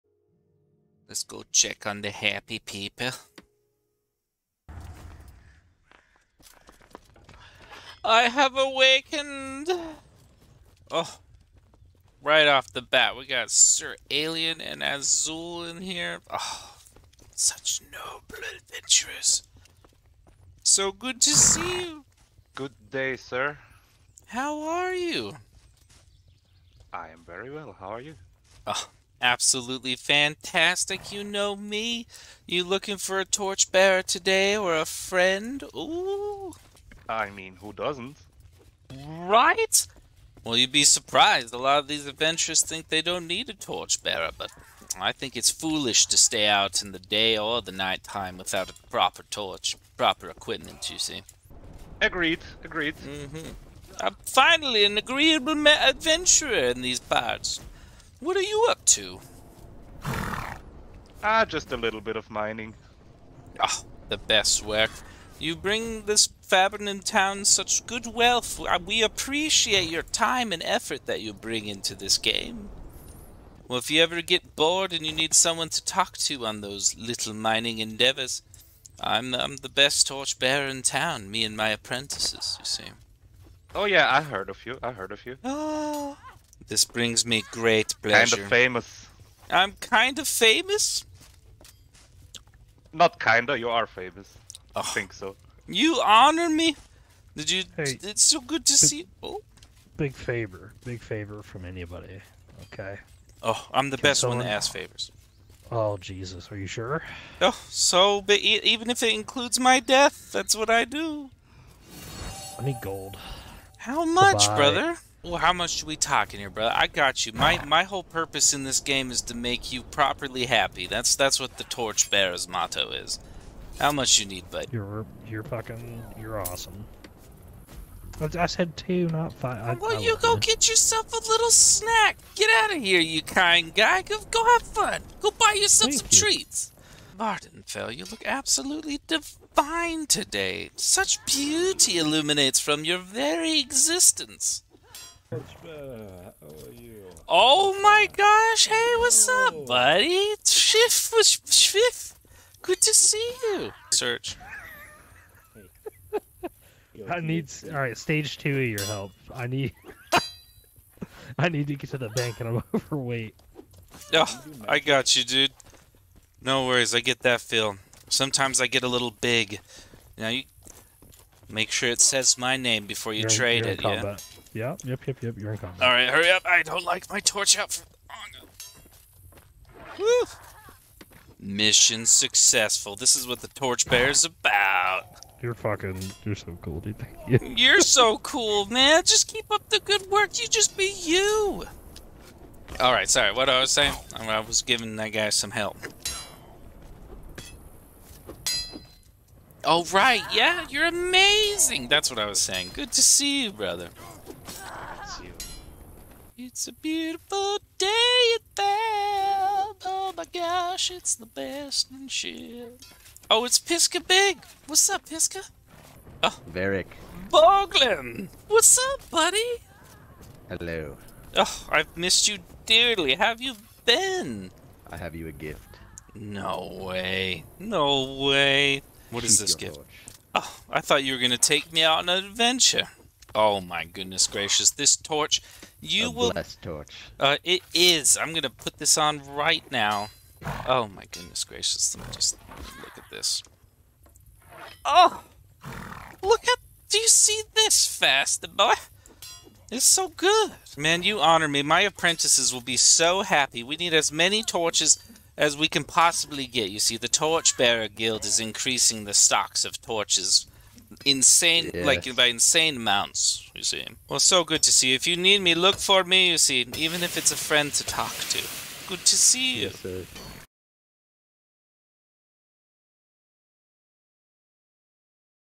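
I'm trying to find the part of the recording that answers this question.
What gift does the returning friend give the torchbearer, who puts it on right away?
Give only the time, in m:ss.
3:56.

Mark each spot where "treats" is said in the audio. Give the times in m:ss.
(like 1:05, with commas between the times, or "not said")
2:16.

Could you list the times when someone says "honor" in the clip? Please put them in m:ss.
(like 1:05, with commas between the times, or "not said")
1:36, 4:11.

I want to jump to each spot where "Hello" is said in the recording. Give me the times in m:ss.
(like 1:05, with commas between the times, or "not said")
3:40.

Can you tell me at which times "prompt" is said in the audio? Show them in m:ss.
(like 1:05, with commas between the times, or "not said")
not said.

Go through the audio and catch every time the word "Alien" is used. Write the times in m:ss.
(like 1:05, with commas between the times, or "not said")
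0:14.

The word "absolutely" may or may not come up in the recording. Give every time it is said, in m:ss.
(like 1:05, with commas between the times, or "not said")
0:29, 2:18.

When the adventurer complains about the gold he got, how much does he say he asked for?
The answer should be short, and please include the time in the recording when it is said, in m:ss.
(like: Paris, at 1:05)
2, at 2:08.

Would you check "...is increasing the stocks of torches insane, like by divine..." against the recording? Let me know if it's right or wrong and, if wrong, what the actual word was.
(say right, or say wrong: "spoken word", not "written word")
wrong: "insane", not "divine".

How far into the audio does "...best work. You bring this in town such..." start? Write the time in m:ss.
1:04.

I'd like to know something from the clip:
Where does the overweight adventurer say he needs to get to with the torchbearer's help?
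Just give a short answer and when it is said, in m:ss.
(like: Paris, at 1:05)
The bank, at 2:41.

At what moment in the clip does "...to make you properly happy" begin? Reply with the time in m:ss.
1:59.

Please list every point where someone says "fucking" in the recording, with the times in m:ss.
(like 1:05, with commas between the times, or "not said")
2:05, 3:05.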